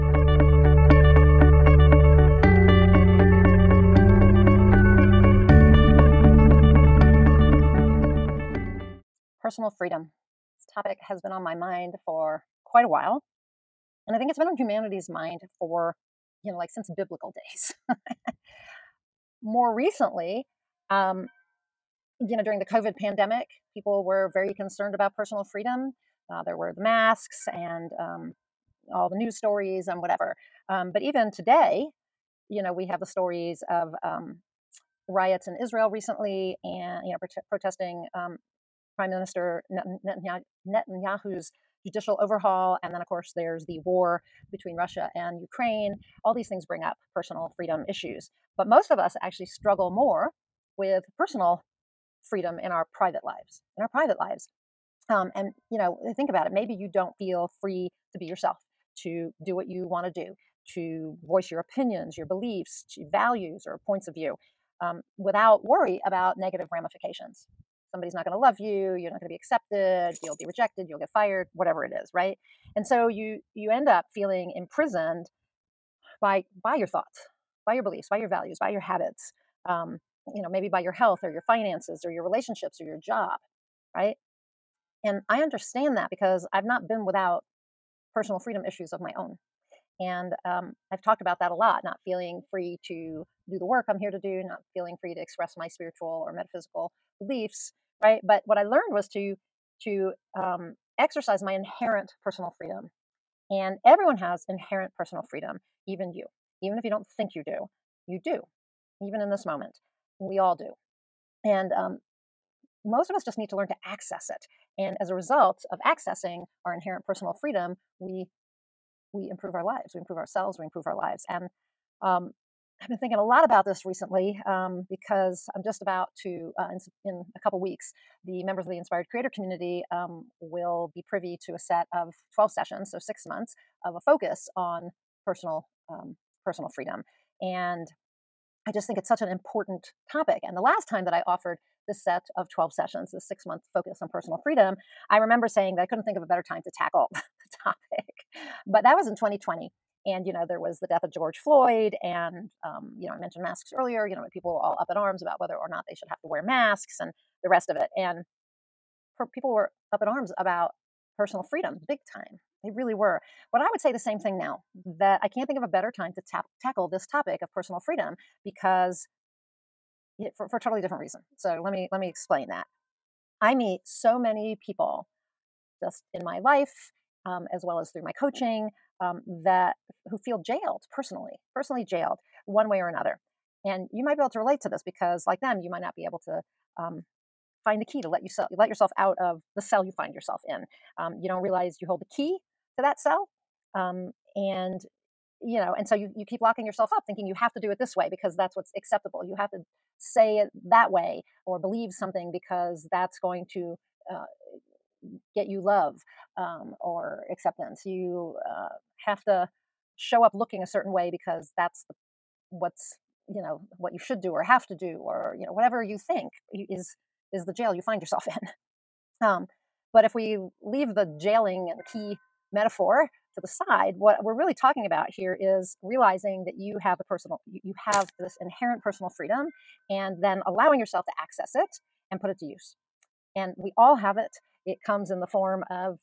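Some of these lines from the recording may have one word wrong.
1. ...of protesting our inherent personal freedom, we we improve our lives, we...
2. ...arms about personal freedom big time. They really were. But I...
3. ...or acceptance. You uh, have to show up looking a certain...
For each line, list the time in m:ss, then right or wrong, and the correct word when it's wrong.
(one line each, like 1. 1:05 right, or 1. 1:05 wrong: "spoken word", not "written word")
1. 1:55 wrong: "accessing", not "protesting"
2. 2:40 right
3. 3:26 right.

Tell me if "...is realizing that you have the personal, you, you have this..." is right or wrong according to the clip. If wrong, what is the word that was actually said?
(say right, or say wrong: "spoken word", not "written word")
right.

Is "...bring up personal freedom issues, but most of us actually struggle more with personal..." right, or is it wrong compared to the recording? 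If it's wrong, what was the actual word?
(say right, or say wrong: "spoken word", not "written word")
right.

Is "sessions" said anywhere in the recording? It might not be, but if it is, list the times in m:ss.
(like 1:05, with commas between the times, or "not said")
2:12, 2:22.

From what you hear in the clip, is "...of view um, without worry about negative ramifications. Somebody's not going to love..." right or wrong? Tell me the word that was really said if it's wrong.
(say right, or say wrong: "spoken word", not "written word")
right.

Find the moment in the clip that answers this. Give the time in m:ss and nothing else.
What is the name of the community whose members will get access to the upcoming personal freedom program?
2:08.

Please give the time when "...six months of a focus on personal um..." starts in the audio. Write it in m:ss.
2:12.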